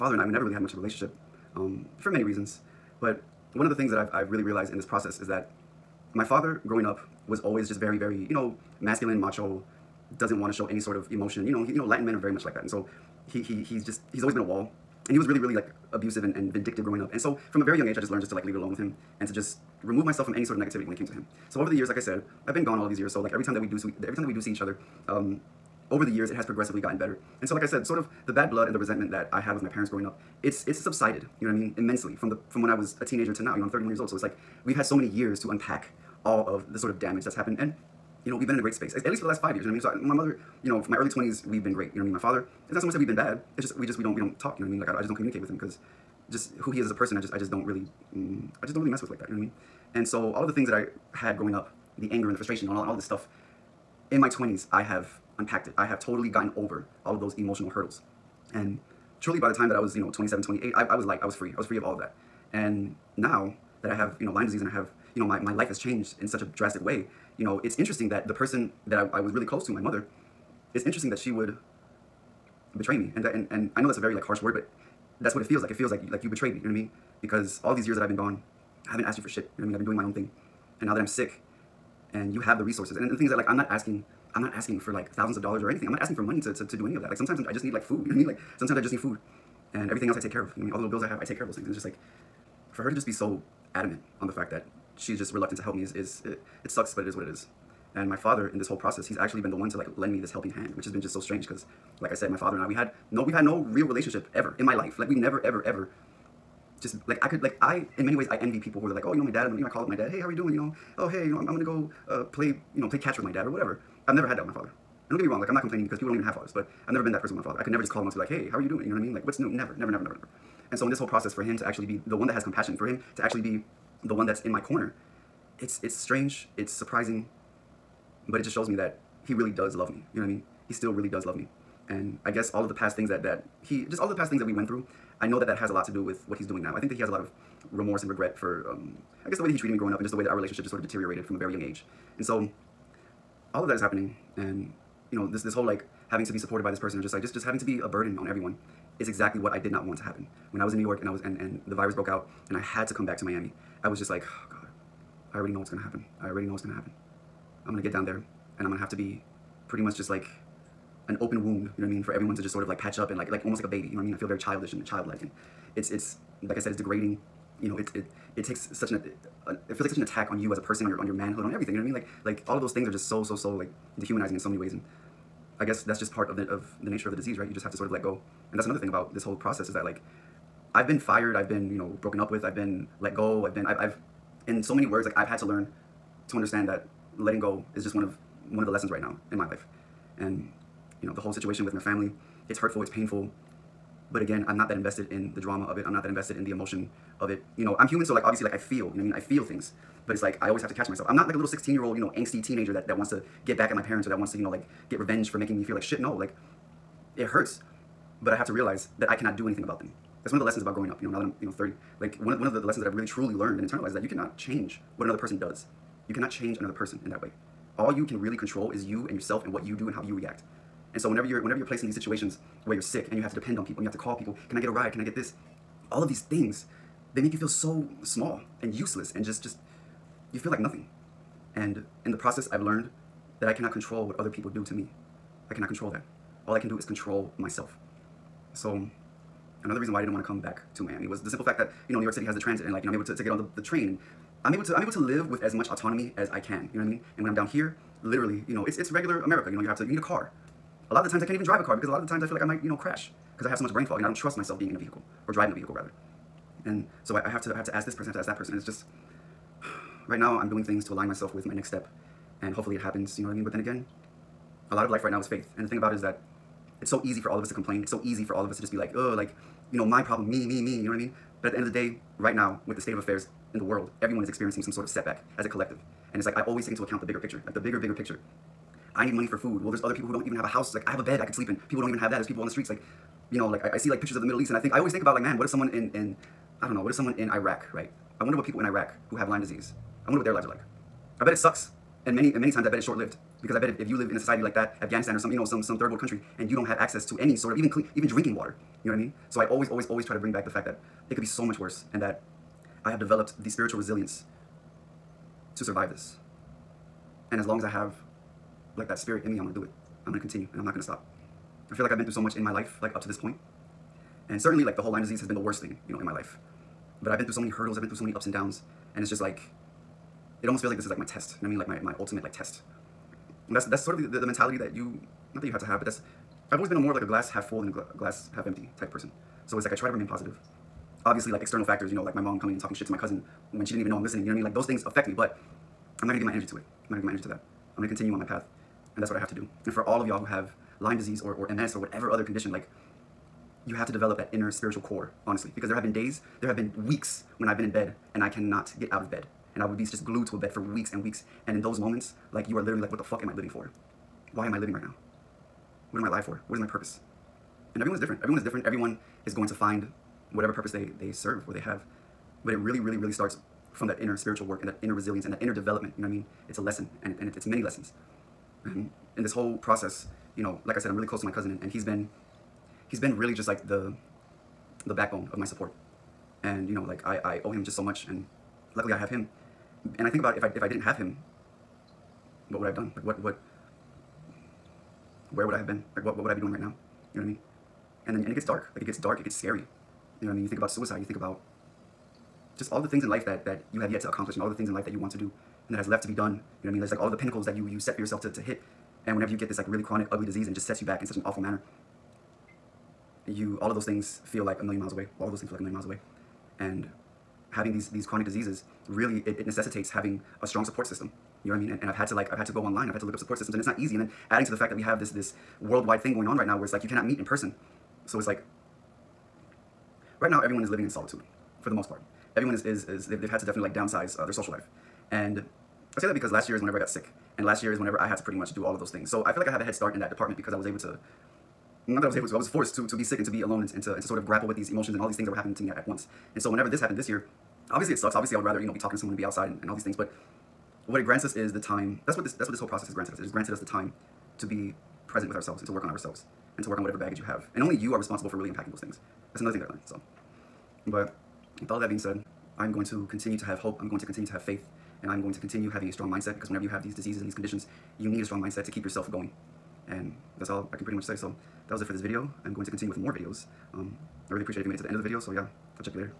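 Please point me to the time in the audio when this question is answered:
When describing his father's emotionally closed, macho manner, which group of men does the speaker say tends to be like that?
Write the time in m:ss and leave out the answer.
0:11.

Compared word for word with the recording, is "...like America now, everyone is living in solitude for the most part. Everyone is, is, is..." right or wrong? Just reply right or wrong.
wrong.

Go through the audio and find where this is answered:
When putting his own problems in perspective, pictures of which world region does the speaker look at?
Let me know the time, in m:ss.
4:44.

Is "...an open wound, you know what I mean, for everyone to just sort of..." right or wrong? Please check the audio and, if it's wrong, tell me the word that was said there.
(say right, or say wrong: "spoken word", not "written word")
right.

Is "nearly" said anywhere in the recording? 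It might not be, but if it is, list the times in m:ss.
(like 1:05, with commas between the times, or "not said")
not said.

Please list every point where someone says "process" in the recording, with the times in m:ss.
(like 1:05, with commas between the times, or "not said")
0:04, 1:38, 2:01, 2:59, 3:52, 6:09, 7:22.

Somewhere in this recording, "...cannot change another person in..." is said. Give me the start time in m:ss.
3:36.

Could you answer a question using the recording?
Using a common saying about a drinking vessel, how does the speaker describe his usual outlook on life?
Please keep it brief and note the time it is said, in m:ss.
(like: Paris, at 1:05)
Glass half full, at 5:27.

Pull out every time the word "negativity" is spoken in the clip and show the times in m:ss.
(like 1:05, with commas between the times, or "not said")
0:20.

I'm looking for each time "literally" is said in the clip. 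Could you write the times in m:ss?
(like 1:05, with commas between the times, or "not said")
4:08, 5:52.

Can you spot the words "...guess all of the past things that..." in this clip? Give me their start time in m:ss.
2:12.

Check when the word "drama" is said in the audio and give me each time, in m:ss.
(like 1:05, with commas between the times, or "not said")
3:15.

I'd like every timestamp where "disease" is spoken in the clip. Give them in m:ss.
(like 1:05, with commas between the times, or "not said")
1:04, 2:57, 4:49, 5:15, 5:40, 6:40, 6:48, 7:36.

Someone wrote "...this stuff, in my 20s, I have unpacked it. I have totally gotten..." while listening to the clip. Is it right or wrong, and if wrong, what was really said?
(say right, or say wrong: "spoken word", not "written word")
right.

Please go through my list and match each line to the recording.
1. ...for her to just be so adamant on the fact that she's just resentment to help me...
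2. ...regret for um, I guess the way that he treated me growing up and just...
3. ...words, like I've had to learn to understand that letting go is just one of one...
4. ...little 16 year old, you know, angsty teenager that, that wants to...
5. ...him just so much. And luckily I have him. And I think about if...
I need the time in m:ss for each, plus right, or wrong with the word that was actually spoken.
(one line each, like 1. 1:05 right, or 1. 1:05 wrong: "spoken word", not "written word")
1. 1:32 wrong: "reluctant", not "resentment"
2. 2:18 right
3. 3:04 right
4. 3:21 right
5. 6:17 right.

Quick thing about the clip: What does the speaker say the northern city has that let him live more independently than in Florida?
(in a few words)
Transit.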